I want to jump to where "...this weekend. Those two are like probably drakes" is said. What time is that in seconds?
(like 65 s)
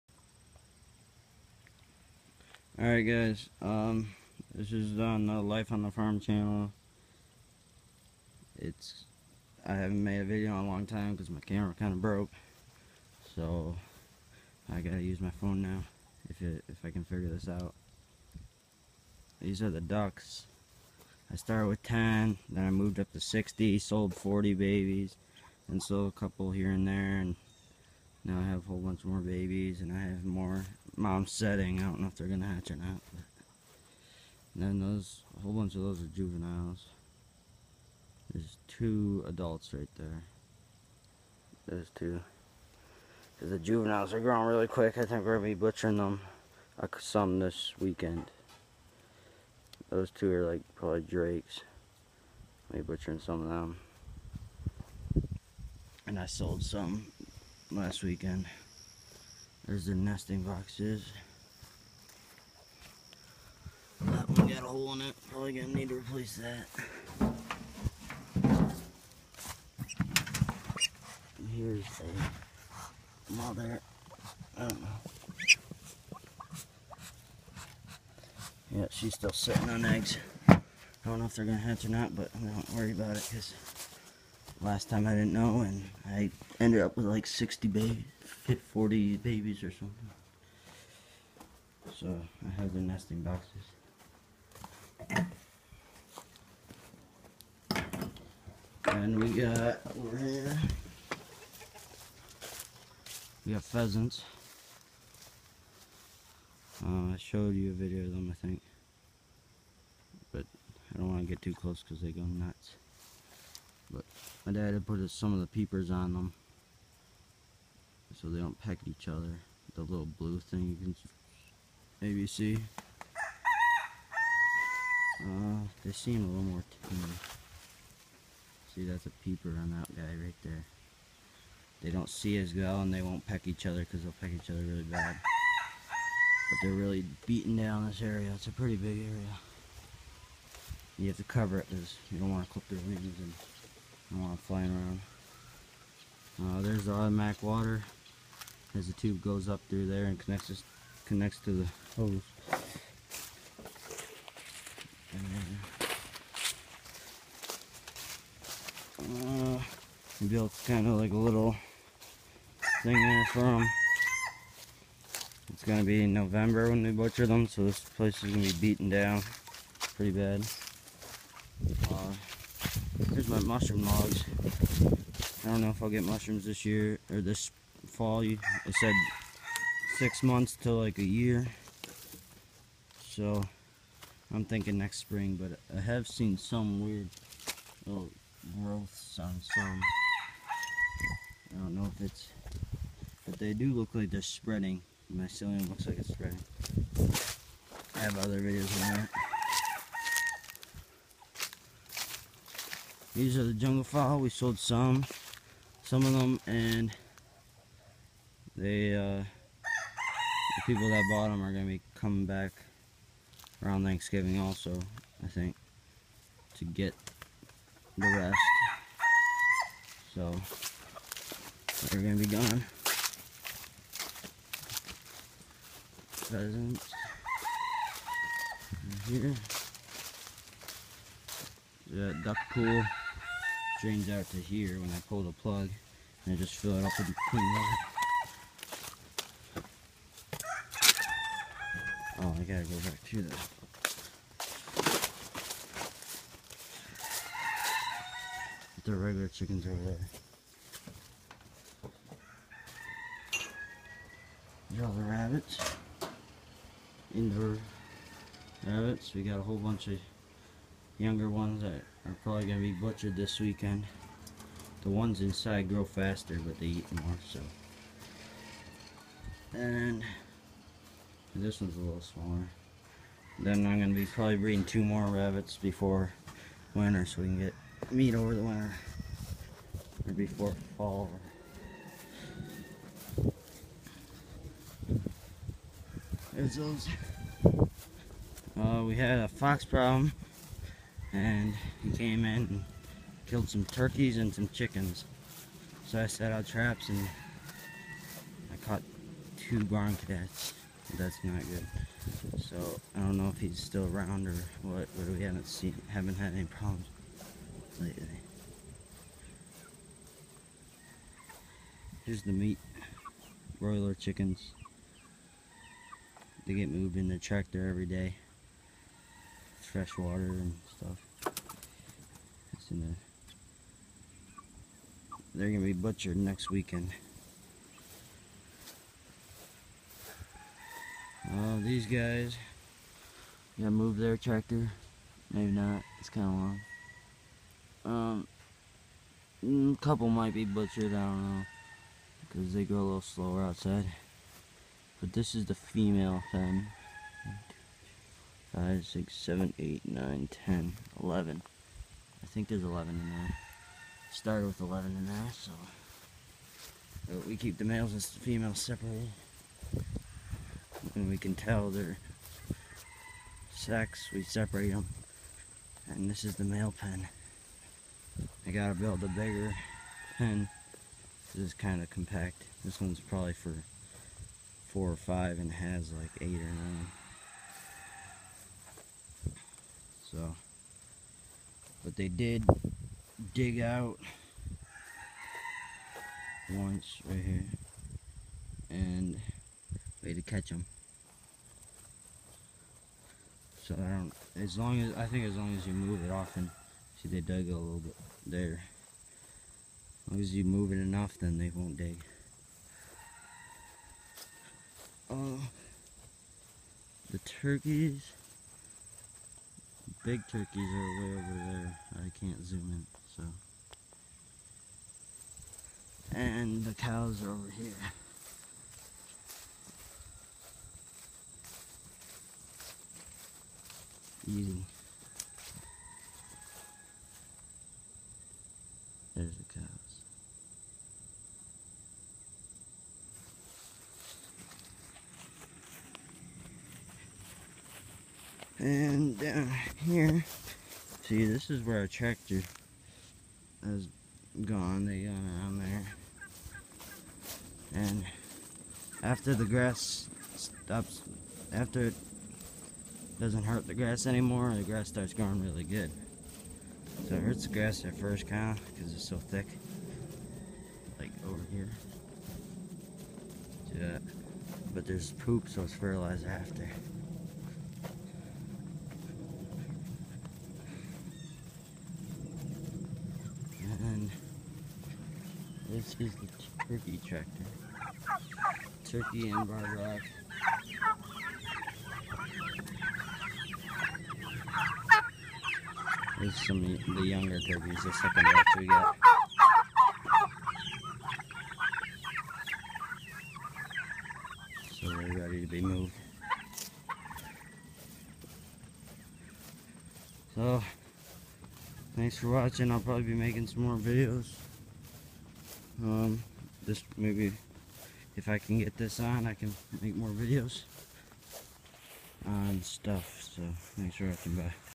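47 s.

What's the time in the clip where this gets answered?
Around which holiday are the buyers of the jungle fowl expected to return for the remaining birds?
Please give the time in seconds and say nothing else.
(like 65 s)
213 s.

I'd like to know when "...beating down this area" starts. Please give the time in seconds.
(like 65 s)
137 s.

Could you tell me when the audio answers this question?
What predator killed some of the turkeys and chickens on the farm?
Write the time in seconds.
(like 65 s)
289 s.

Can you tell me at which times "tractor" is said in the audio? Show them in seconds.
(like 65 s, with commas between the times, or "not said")
317 s, 334 s, 441 s, 477 s.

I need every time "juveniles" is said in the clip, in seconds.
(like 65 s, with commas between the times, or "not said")
36 s, 43 s.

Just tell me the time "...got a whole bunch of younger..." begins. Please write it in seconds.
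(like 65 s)
259 s.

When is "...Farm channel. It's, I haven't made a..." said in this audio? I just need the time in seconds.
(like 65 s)
5 s.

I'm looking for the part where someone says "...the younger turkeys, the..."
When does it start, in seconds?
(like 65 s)
486 s.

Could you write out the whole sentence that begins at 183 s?
So I'm thinking next spring, but I have seen some weird little growths on some.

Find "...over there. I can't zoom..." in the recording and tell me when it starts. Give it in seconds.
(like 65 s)
411 s.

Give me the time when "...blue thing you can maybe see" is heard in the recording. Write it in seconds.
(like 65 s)
120 s.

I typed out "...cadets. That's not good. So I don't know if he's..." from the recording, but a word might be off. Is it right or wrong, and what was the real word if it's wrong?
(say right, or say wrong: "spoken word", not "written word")
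right.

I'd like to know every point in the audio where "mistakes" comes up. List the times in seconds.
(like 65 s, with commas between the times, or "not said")
not said.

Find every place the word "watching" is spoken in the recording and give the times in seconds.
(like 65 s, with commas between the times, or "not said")
502 s, 514 s.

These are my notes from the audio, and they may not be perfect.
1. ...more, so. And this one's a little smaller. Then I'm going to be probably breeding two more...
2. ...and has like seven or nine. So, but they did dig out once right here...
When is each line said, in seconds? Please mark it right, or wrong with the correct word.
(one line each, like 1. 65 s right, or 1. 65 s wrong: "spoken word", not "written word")
1. 266 s right
2. 375 s wrong: "eight", not "seven".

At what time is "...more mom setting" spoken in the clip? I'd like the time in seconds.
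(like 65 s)
30 s.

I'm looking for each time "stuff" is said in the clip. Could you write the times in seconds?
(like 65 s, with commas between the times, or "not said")
320 s, 512 s.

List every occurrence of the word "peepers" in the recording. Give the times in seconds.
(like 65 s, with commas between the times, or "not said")
115 s, 129 s.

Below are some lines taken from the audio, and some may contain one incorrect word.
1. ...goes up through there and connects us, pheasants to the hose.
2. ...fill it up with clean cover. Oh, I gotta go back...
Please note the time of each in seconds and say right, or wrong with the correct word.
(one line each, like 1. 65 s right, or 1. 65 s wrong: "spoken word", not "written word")
1. 149 s wrong: "connects", not "pheasants"
2. 236 s wrong: "water", not "cover".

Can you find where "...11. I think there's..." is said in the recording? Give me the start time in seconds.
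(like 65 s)
351 s.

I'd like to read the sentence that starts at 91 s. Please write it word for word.
So I have the nesting boxes.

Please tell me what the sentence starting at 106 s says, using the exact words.
Uh, I showed you a video of them, I think.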